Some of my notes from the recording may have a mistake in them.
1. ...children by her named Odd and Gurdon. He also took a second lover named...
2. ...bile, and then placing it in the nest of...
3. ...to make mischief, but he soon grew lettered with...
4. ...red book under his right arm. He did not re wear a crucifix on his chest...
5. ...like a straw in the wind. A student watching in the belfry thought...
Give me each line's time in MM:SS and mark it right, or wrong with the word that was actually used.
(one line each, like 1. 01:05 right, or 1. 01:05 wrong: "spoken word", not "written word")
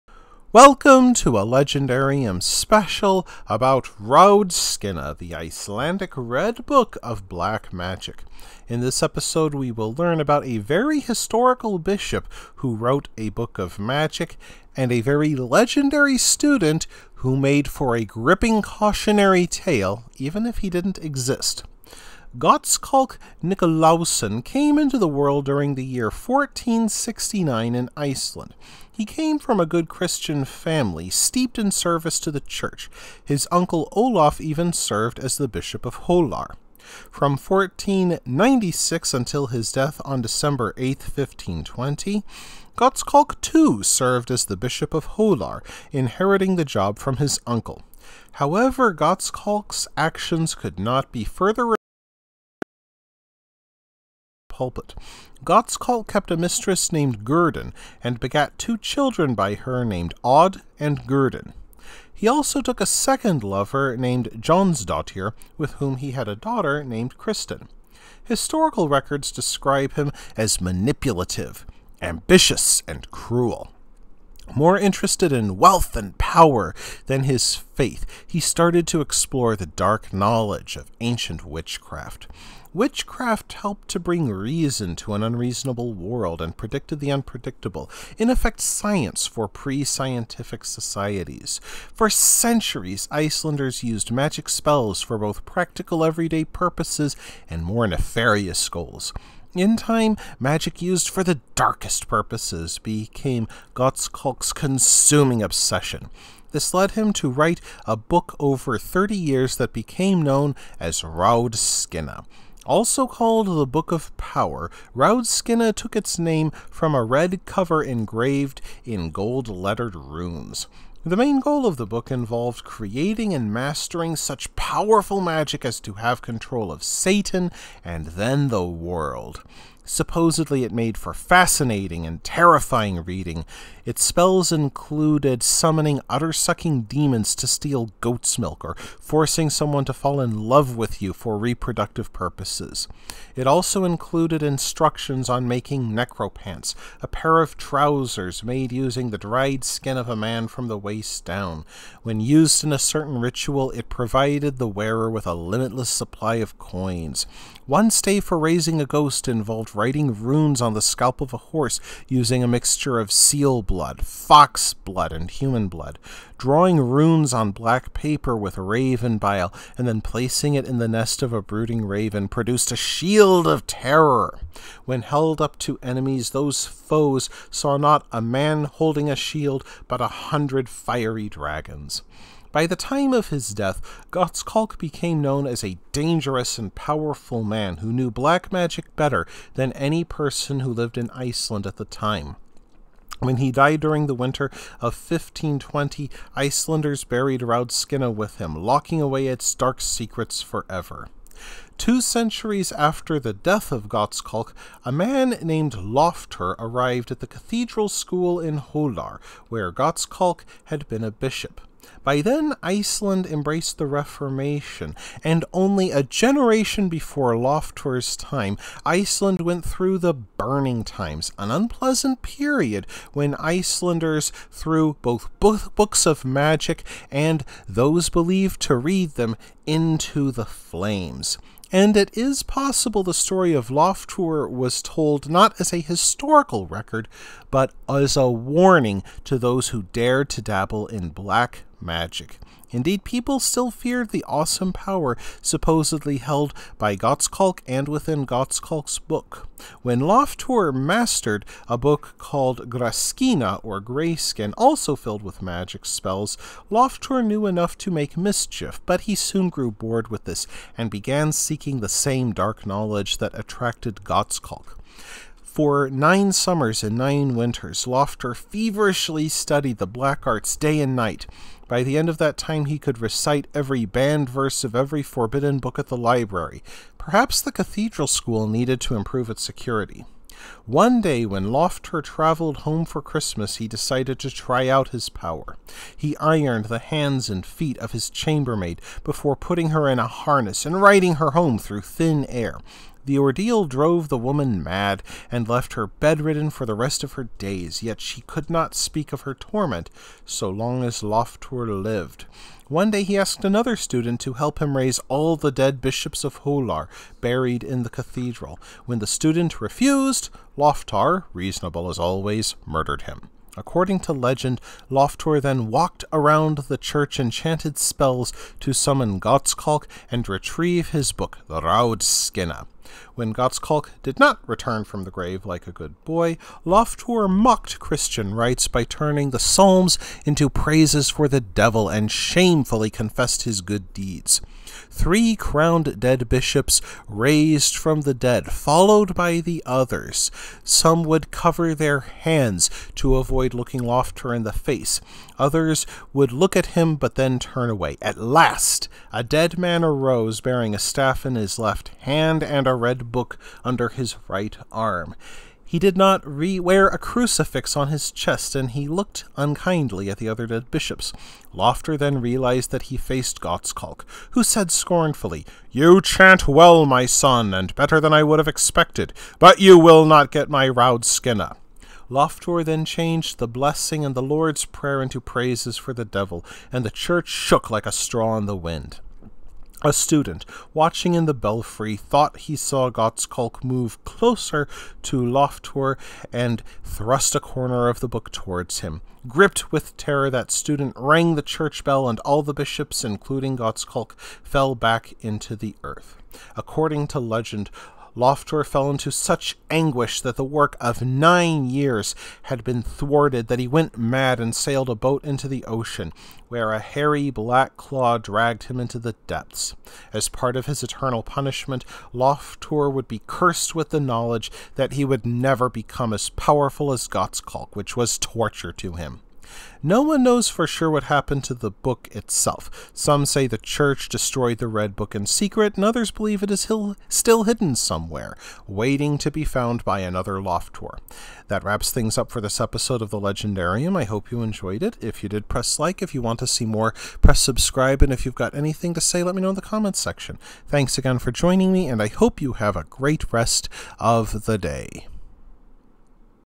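1. 00:58 right
2. 02:49 right
3. 04:17 wrong: "bored", not "lettered"
4. 05:52 right
5. 06:17 right.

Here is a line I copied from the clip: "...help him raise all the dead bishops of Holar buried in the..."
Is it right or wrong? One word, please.
right.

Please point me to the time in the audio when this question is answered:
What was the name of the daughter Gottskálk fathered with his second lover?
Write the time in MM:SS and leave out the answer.
01:07.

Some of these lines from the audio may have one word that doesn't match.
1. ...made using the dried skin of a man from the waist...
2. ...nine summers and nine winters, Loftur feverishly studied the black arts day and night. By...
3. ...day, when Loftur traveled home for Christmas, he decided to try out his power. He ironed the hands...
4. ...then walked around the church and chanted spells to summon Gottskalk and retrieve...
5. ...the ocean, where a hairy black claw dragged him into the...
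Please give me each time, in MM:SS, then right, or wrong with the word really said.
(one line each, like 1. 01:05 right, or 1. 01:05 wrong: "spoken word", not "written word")
1. 02:28 right
2. 04:25 right
3. 04:40 right
4. 05:15 right
5. 06:45 right.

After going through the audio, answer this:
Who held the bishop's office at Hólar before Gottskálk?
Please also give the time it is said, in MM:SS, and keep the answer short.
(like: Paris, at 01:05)
His uncle Olaf, at 00:33.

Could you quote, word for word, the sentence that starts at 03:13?
When he died during the winter of 1520, Icelanders buried Raudskinna with him, locking away its dark secrets forever.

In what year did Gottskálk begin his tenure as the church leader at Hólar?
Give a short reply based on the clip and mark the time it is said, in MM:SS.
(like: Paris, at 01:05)
1496, at 00:37.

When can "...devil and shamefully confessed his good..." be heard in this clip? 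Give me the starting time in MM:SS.
05:31.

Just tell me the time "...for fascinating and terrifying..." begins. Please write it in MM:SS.
02:10.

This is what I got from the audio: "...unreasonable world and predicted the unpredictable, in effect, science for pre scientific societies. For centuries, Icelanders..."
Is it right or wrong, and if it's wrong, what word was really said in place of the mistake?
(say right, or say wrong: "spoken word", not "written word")
right.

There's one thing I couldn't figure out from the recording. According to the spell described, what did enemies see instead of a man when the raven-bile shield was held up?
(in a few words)
A hundred fiery dragons.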